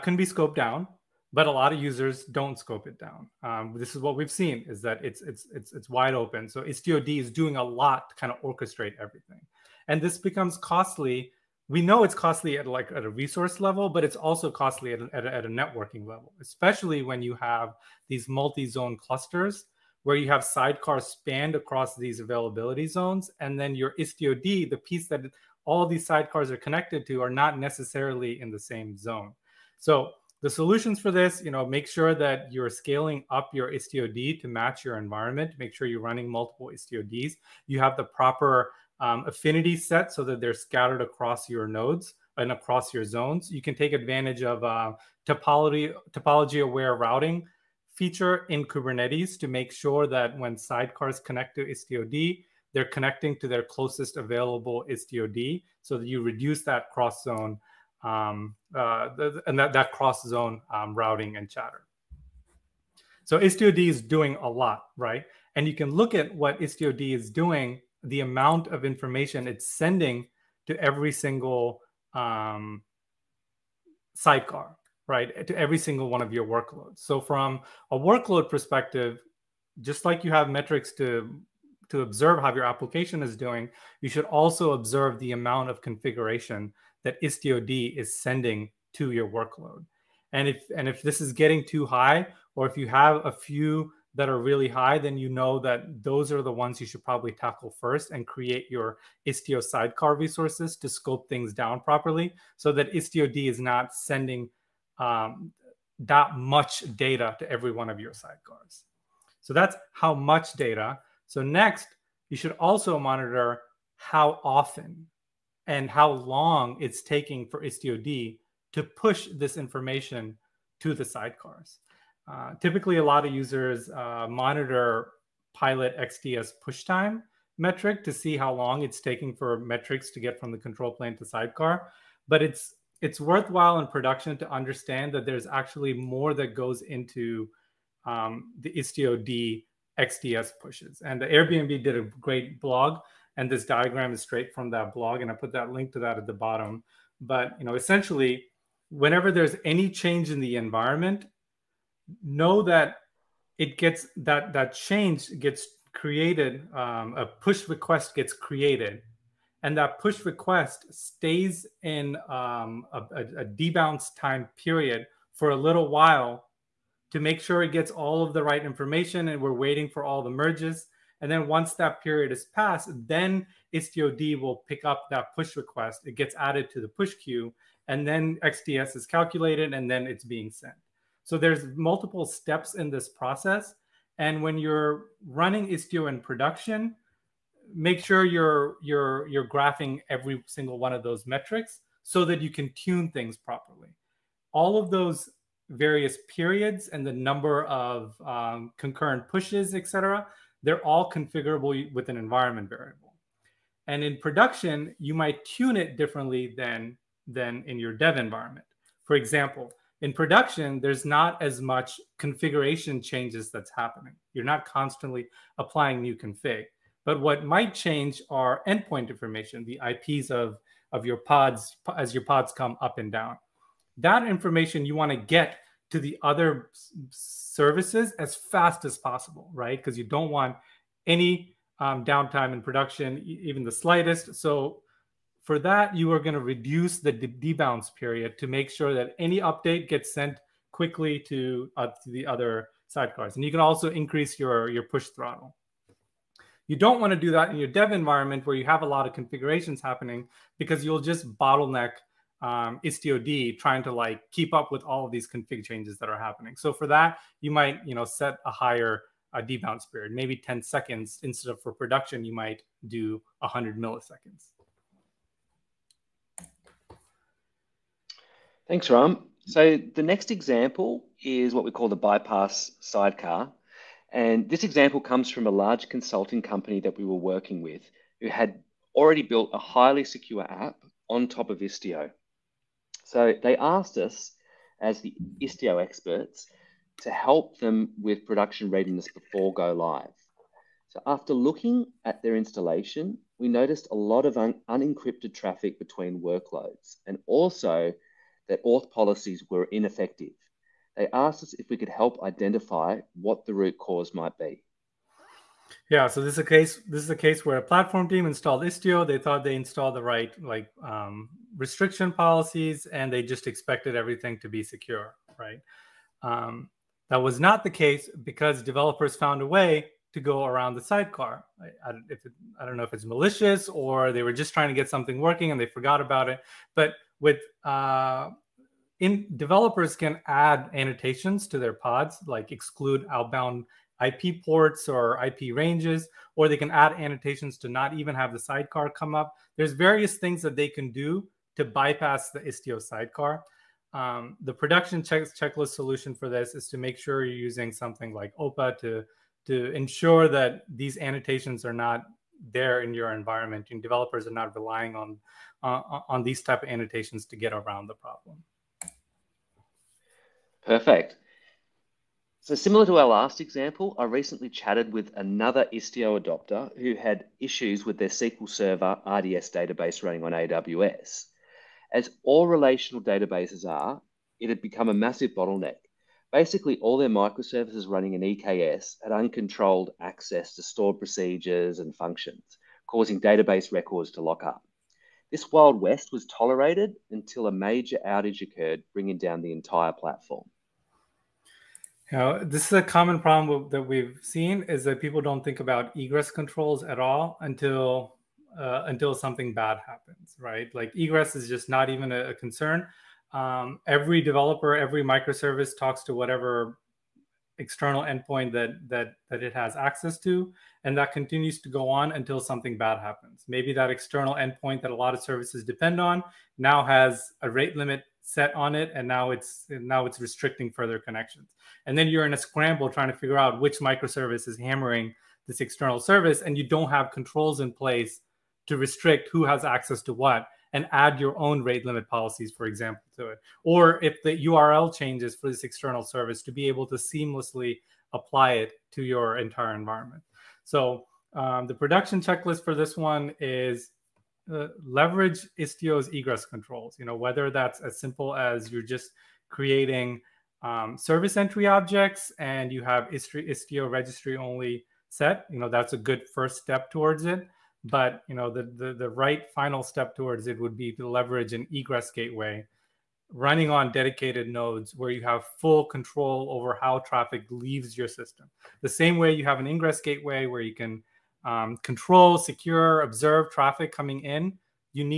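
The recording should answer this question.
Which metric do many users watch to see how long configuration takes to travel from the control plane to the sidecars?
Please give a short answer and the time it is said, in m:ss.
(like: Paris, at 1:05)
Pilot XDS push time, at 2:05.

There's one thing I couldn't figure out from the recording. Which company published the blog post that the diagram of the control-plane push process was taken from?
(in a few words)
Airbnb.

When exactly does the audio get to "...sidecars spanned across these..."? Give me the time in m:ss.
0:20.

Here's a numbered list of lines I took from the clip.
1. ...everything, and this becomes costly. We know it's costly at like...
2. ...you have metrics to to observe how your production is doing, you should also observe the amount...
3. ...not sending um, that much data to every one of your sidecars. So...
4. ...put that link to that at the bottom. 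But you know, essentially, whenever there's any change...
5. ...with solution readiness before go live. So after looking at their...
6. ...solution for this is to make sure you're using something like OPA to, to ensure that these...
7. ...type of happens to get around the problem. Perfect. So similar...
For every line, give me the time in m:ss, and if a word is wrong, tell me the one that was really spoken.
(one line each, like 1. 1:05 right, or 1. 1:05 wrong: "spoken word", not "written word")
1. 0:08 right
2. 1:20 wrong: "application", not "production"
3. 1:43 right
4. 2:25 right
5. 4:48 wrong: "production", not "solution"
6. 5:45 right
7. 5:56 wrong: "annotations", not "happens".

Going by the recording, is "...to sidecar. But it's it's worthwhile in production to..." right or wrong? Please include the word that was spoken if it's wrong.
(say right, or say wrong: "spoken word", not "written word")
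right.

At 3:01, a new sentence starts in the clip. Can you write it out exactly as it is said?
So there's multiple steps in this process.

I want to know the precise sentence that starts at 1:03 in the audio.
So istiod is doing a lot, right?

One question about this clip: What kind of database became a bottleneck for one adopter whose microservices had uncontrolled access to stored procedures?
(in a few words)
SQL Server RDS.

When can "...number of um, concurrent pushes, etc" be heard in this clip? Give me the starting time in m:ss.
3:17.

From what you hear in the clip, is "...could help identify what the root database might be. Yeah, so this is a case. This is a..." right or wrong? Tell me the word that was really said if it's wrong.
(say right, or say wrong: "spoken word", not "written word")
wrong: "cause", not "database".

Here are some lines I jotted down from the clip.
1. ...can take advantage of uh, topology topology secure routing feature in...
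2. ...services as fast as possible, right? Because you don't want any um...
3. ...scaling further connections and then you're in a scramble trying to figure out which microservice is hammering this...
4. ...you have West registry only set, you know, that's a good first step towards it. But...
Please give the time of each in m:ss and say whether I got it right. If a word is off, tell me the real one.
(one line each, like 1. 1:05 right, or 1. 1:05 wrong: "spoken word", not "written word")
1. 0:43 wrong: "aware", not "secure"
2. 3:47 right
3. 7:00 wrong: "restricting", not "scaling"
4. 7:32 wrong: "Istio", not "West".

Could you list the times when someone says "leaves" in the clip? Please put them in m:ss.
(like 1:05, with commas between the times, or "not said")
7:47.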